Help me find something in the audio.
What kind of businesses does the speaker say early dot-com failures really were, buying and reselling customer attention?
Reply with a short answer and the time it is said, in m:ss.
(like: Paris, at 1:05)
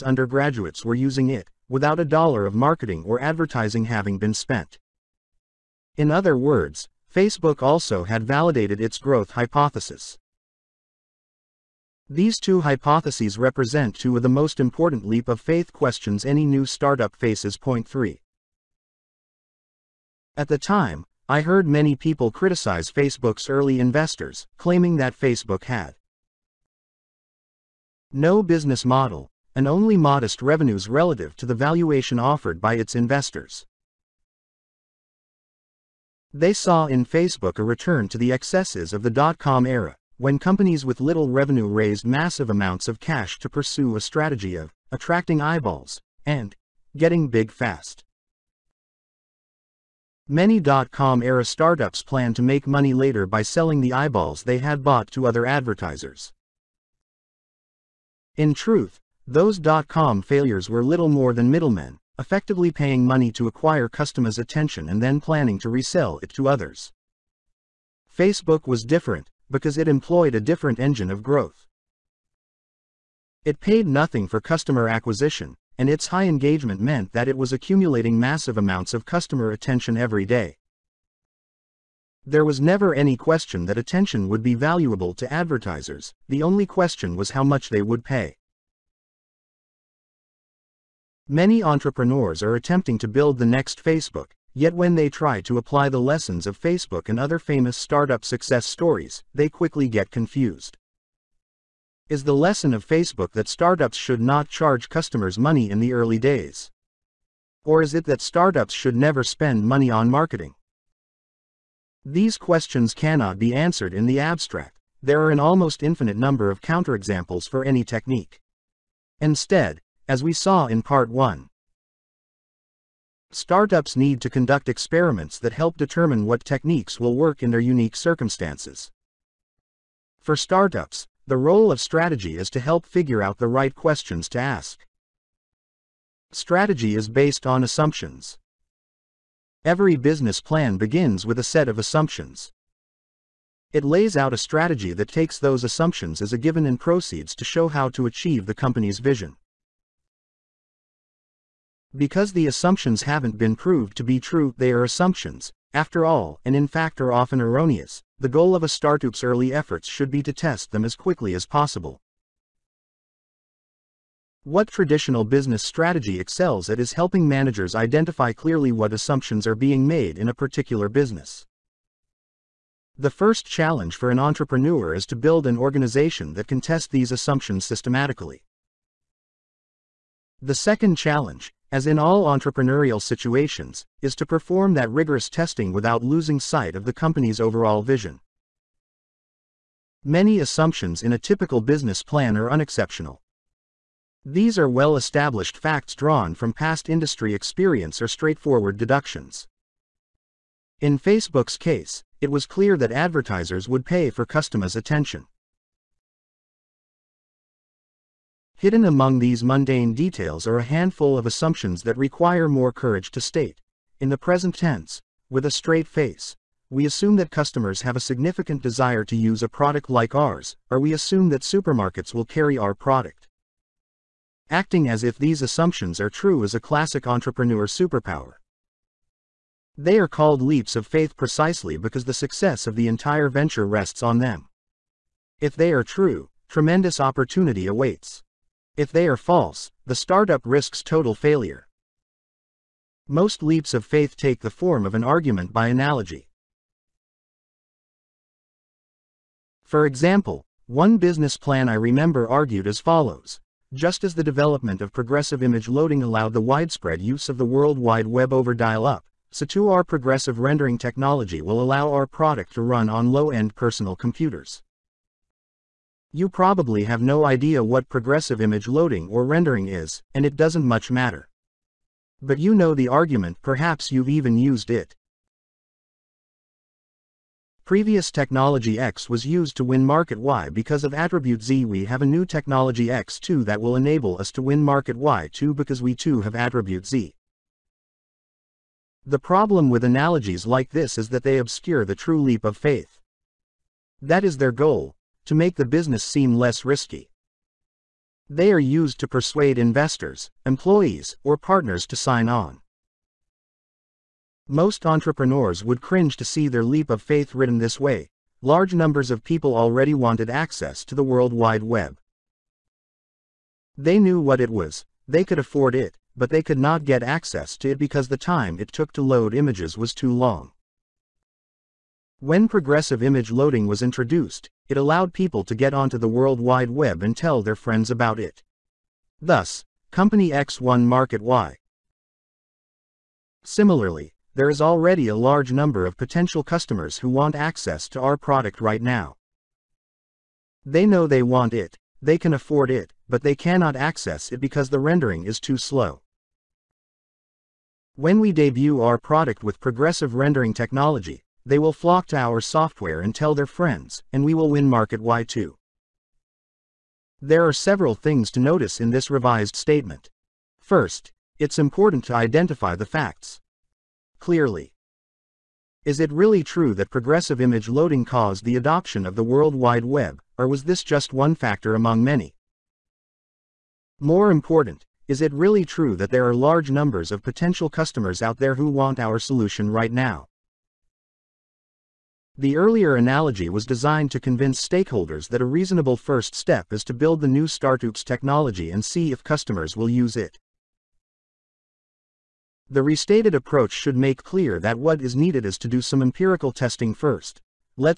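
middlemen, at 1:01.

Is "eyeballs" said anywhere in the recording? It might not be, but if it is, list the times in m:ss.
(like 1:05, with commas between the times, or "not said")
0:45, 0:53.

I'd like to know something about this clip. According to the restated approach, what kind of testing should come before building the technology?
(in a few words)
empirical testing.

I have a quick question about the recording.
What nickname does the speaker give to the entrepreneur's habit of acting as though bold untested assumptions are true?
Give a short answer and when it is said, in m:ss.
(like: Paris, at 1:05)
entrepreneur superpower, at 3:47.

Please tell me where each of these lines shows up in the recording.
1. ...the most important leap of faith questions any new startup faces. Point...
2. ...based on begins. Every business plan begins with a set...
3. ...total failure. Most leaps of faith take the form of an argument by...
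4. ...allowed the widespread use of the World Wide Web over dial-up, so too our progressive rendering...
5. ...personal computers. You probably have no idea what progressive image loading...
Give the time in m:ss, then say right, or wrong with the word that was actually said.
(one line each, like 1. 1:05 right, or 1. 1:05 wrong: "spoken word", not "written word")
1. 0:14 right
2. 2:17 wrong: "assumptions", not "begins"
3. 4:00 right
4. 4:16 right
5. 4:23 right.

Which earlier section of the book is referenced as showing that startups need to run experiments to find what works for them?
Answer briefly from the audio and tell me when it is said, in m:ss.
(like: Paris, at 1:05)
Part 1, at 2:00.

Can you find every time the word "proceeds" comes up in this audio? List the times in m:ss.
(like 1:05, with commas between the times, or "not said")
2:26.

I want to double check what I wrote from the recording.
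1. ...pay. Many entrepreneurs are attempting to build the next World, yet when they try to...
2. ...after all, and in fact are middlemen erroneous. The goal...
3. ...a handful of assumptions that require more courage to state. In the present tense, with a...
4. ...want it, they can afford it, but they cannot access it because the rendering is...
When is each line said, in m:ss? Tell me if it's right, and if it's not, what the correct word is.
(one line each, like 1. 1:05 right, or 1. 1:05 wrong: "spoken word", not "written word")
1. 1:28 wrong: "Facebook", not "World"
2. 2:35 wrong: "often", not "middlemen"
3. 3:30 right
4. 5:41 right.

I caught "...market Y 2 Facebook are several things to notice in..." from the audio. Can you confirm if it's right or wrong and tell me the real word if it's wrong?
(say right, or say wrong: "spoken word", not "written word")
wrong: "There", not "Facebook".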